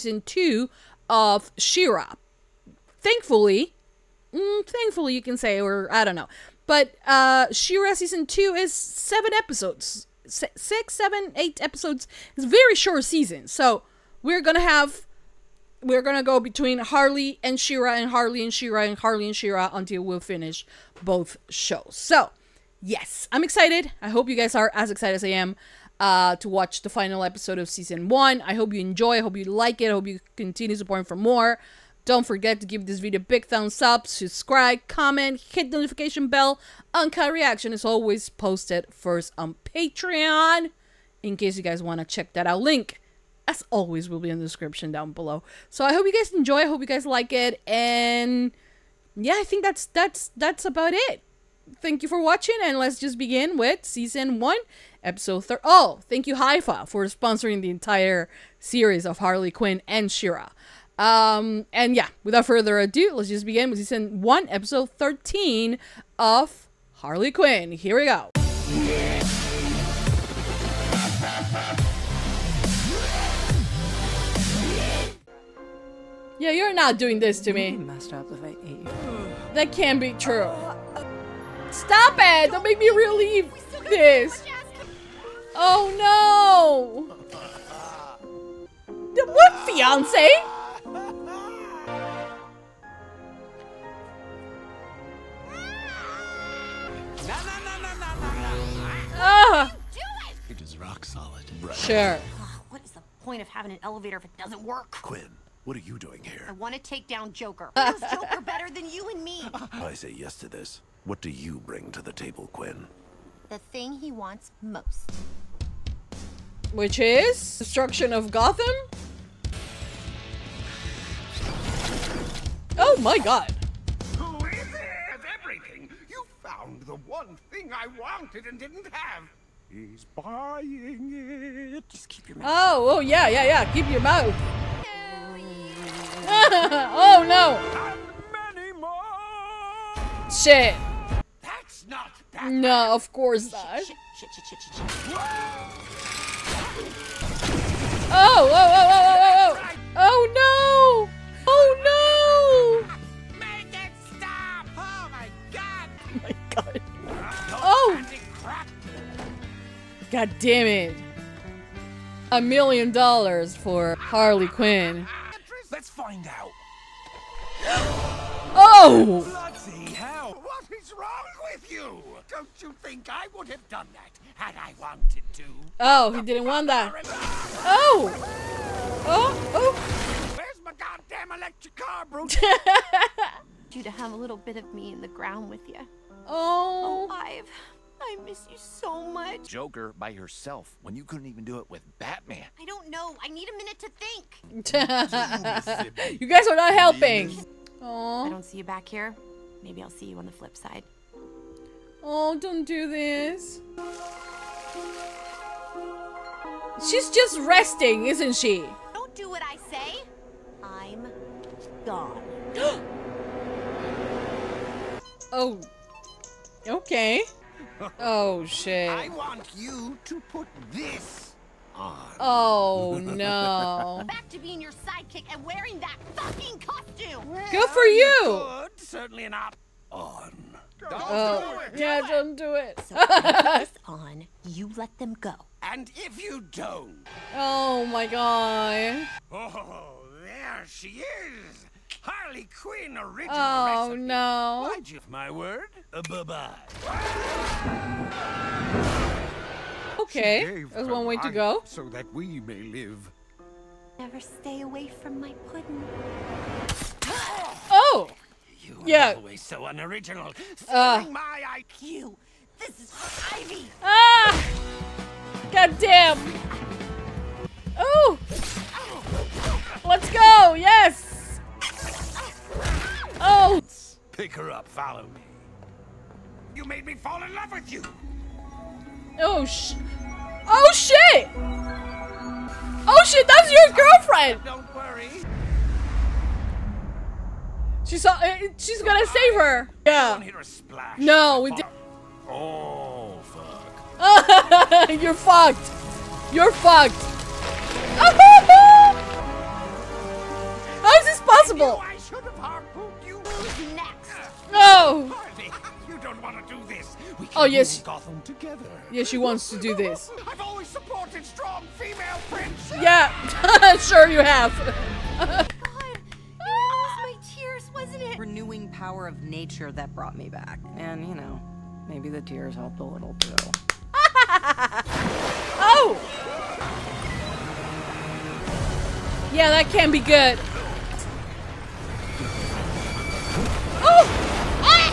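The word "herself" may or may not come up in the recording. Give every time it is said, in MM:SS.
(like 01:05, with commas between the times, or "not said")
03:10.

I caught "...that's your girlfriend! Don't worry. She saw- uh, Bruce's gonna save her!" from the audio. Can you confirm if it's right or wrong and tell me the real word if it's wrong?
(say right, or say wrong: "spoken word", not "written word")
wrong: "She", not "Bruce".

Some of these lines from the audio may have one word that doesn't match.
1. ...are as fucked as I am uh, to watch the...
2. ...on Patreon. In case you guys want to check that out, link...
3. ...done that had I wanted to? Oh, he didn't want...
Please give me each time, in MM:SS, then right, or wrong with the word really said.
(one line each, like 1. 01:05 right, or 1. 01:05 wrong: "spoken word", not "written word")
1. 00:24 wrong: "excited", not "fucked"
2. 00:39 right
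3. 02:53 right.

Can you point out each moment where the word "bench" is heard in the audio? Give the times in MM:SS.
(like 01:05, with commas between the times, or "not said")
not said.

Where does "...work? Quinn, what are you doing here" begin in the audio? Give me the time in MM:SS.
01:44.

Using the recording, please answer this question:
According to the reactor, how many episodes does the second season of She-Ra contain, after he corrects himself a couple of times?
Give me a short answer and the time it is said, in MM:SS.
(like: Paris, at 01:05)
8, at 00:11.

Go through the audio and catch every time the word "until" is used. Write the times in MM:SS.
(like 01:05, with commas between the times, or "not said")
00:19.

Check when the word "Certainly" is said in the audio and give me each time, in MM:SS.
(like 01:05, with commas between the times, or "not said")
03:48.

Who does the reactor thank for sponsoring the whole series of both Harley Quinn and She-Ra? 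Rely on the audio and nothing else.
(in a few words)
Haifa.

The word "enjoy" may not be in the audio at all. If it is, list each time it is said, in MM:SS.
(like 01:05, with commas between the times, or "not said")
00:28, 00:46.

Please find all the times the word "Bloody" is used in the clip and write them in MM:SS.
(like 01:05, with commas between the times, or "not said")
02:49.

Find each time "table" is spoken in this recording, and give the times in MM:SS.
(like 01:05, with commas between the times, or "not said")
01:52.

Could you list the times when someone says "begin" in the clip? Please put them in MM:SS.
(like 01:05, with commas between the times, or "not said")
00:53, 01:03.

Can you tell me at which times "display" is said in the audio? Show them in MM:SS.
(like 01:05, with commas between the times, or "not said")
not said.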